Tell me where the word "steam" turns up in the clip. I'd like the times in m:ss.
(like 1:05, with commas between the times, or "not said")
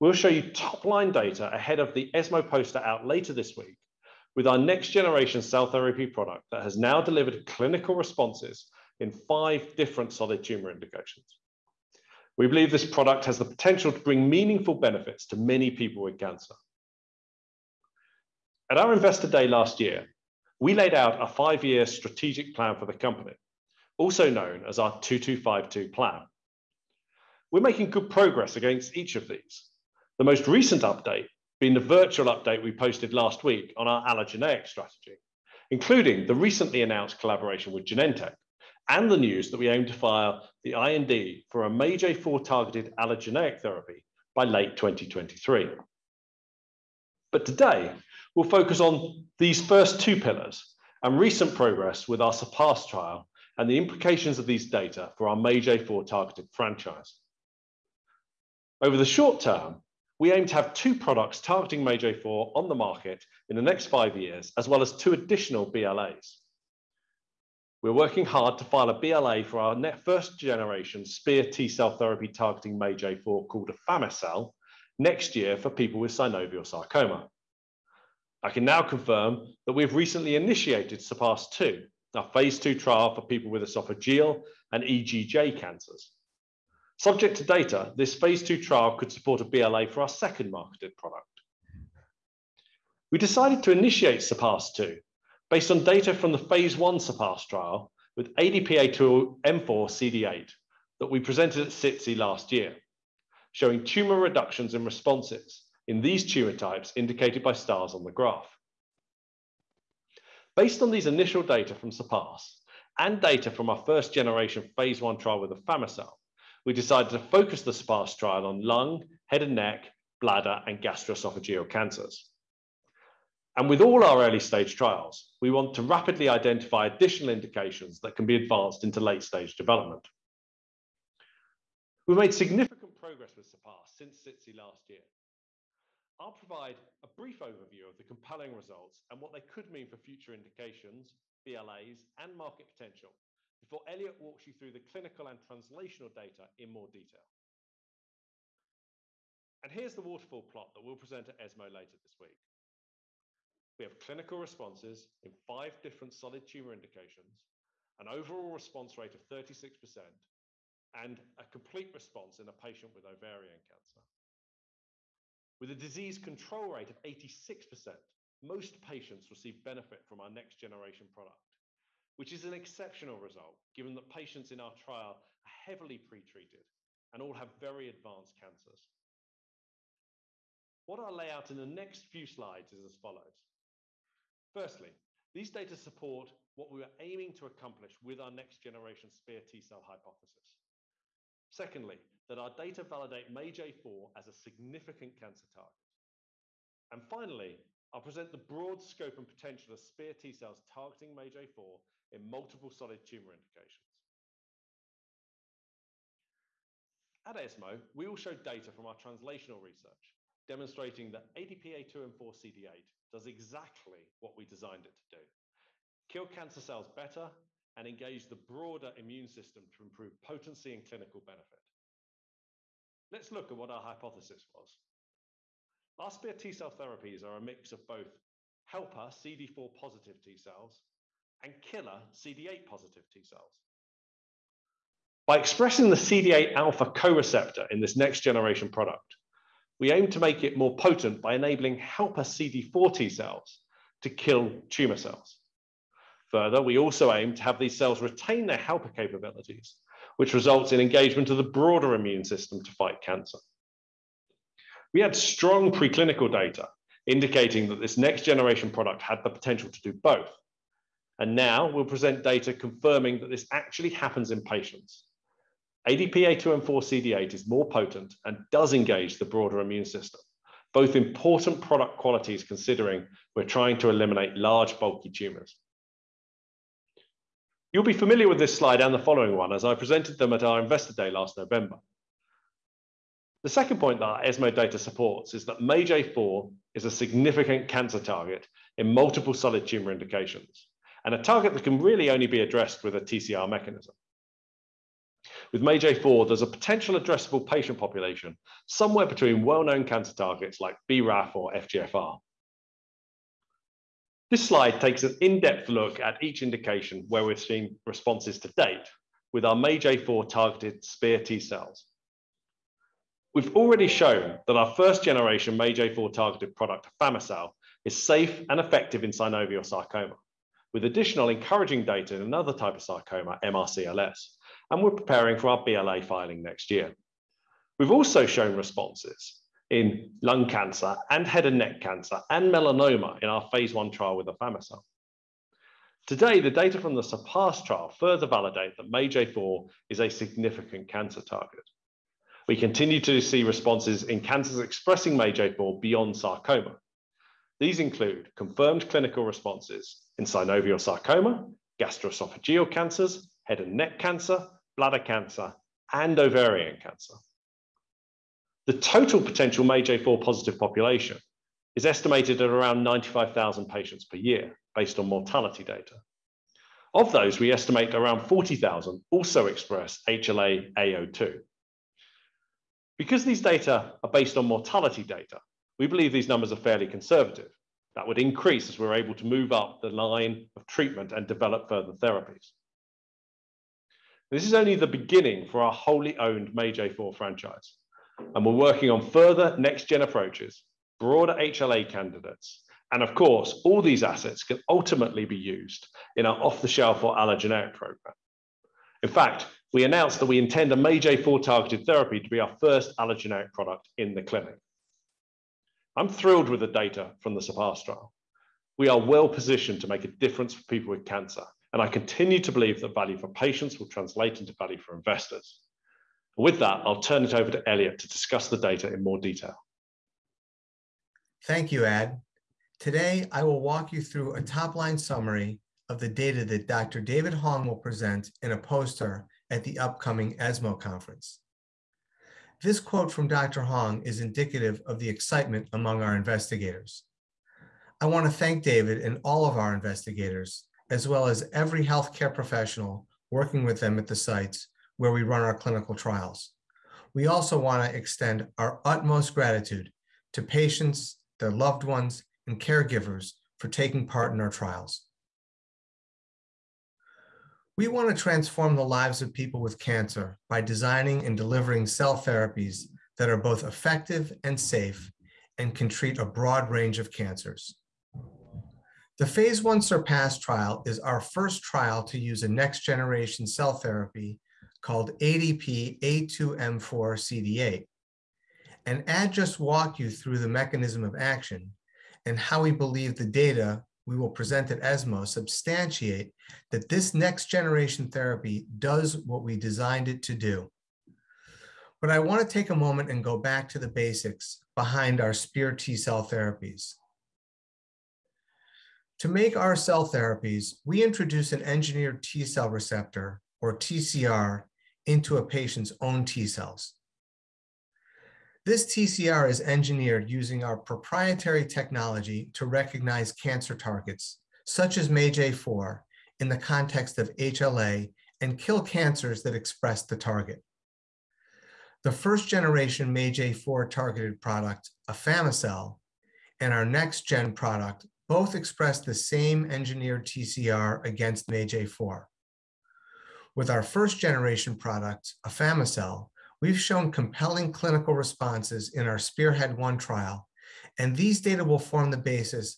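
not said.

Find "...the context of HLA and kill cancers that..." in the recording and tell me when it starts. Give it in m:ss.
8:36.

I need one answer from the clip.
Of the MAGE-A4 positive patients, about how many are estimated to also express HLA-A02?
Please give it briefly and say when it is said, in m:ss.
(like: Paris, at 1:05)
40,000, at 6:08.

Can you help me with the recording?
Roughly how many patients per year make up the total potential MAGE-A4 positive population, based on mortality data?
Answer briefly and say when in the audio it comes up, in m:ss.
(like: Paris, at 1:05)
95,000, at 6:02.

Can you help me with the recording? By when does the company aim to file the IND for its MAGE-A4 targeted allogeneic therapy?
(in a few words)
late 2023.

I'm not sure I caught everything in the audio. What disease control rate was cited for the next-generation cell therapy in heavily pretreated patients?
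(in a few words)
86%.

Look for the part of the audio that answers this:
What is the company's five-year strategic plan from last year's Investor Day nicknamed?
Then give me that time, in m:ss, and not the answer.
0:25.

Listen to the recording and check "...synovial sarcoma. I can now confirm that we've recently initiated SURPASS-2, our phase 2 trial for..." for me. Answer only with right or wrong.
right.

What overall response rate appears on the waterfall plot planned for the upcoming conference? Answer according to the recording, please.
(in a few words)
36%.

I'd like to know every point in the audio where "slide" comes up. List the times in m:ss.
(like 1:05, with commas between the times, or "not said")
3:02, 4:38, 5:04.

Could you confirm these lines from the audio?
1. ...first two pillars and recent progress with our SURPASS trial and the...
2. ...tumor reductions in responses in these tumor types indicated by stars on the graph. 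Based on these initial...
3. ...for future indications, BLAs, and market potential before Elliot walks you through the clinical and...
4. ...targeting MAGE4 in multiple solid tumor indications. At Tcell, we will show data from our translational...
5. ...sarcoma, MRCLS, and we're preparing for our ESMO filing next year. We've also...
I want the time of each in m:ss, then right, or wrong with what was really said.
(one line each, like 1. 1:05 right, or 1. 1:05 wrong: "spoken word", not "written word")
1. 0:49 right
2. 1:43 right
3. 2:19 right
4. 3:20 wrong: "ESMO", not "Tcell"
5. 5:22 wrong: "BLA", not "ESMO".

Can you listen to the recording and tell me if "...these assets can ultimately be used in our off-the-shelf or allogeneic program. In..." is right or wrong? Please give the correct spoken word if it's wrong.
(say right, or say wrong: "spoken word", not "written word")
right.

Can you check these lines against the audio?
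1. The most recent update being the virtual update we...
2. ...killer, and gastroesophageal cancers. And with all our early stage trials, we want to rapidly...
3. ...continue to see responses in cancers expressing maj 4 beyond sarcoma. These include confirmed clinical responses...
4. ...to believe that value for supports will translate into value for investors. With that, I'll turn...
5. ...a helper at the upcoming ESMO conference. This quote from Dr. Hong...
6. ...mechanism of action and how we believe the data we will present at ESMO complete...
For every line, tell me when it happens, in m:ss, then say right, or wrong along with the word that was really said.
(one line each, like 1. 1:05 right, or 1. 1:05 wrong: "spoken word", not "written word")
1. 0:30 right
2. 2:00 wrong: "bladder", not "killer"
3. 5:42 right
4. 6:52 wrong: "patients", not "supports"
5. 7:08 wrong: "poster", not "helper"
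6. 8:00 wrong: "substantiate", not "complete".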